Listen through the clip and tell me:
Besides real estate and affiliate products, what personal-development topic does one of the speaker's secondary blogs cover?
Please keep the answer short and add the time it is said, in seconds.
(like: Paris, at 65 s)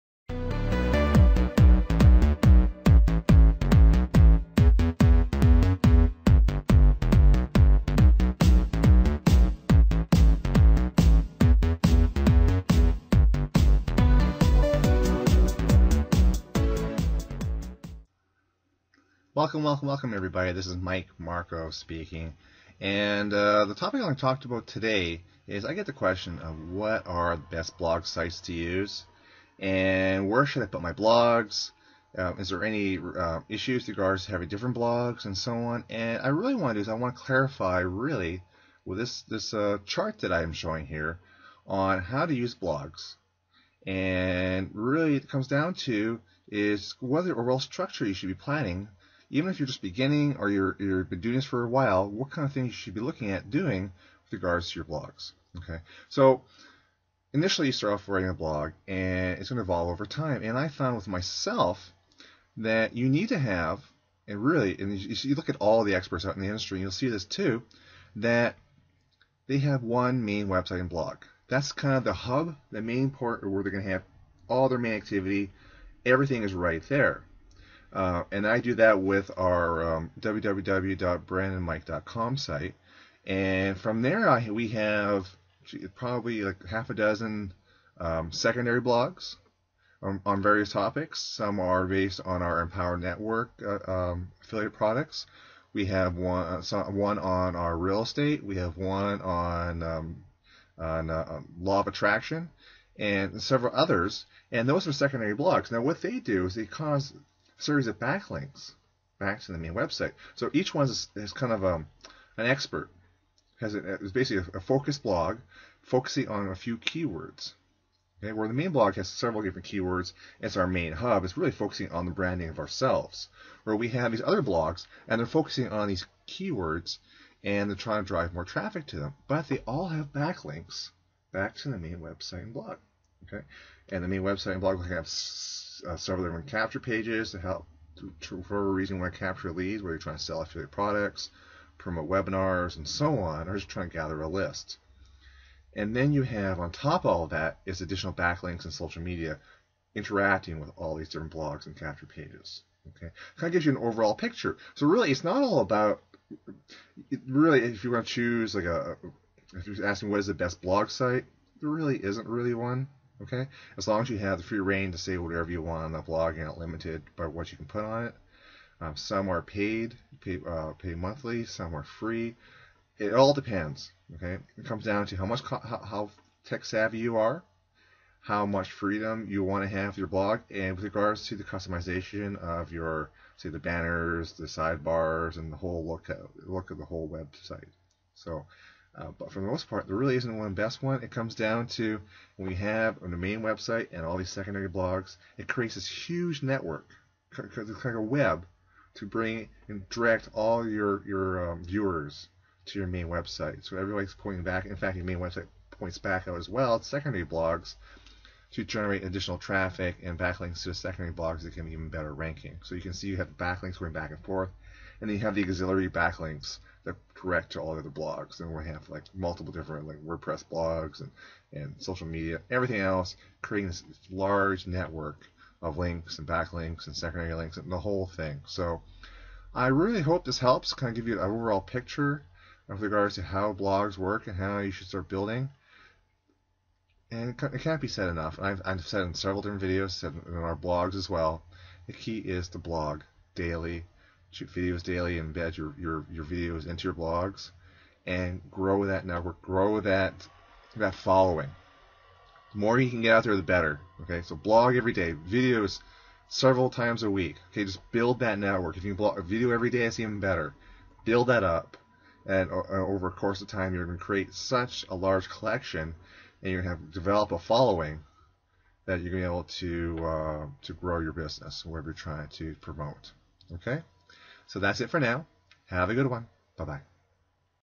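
law of attraction, at 101 s.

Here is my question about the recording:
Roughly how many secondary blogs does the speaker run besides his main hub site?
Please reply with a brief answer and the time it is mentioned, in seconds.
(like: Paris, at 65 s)
half a dozen, at 86 s.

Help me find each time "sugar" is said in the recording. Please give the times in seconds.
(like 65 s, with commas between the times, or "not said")
not said.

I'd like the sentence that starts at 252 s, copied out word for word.
The more you can get out there, the better.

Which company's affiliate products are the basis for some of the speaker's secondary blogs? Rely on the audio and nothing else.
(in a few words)
Empower Network.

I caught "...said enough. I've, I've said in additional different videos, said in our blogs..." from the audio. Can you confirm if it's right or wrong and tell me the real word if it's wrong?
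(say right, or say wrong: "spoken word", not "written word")
wrong: "several", not "additional".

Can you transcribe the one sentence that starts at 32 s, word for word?
Uh, is there any uh, issues with regards to having different blogs and so on?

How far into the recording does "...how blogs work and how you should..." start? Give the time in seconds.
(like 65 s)
233 s.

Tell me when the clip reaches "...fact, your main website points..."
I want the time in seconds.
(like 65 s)
204 s.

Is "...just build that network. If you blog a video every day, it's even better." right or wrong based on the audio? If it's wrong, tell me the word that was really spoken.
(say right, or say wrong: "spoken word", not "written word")
right.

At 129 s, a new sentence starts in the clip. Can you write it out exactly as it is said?
But they all have backlinks back to the main website and blog.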